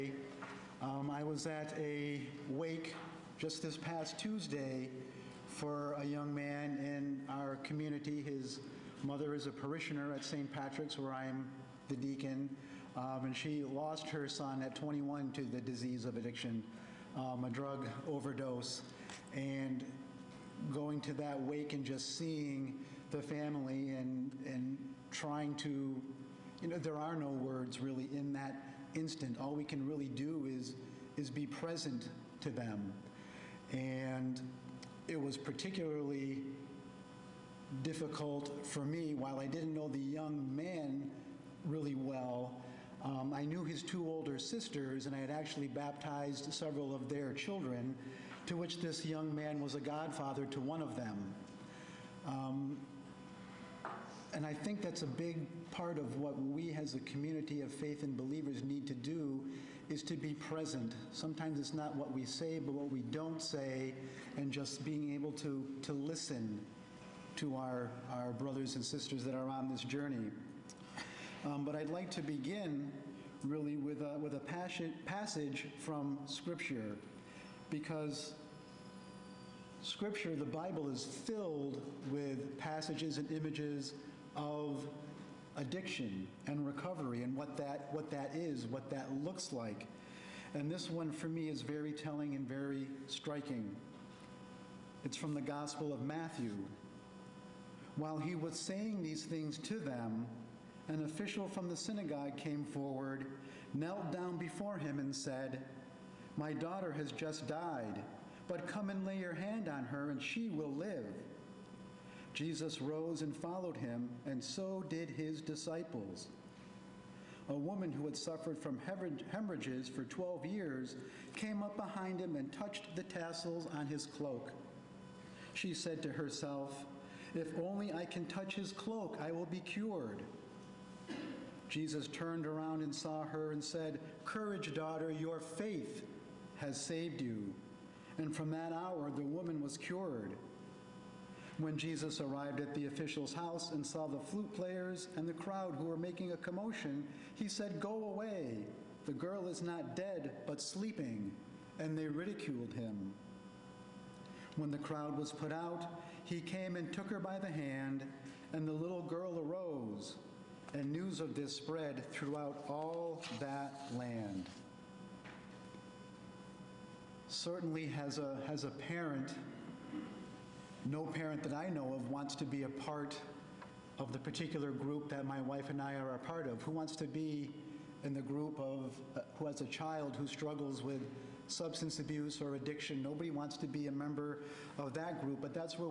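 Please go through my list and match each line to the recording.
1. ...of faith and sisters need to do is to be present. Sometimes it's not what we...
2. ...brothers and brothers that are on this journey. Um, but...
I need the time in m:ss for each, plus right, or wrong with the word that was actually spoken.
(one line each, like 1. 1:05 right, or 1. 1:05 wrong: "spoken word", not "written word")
1. 0:57 wrong: "believers", not "sisters"
2. 1:08 wrong: "sisters", not "brothers".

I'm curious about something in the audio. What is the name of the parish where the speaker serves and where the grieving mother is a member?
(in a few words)
St. Patrick's.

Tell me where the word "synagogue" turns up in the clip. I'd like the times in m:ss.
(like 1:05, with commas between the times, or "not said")
1:41.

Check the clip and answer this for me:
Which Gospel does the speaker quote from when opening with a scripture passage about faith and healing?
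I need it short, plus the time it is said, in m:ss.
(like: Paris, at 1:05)
Matthew, at 1:36.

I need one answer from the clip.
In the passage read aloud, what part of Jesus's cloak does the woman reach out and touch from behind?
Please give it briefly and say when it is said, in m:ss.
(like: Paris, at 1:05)
The tassels, at 2:03.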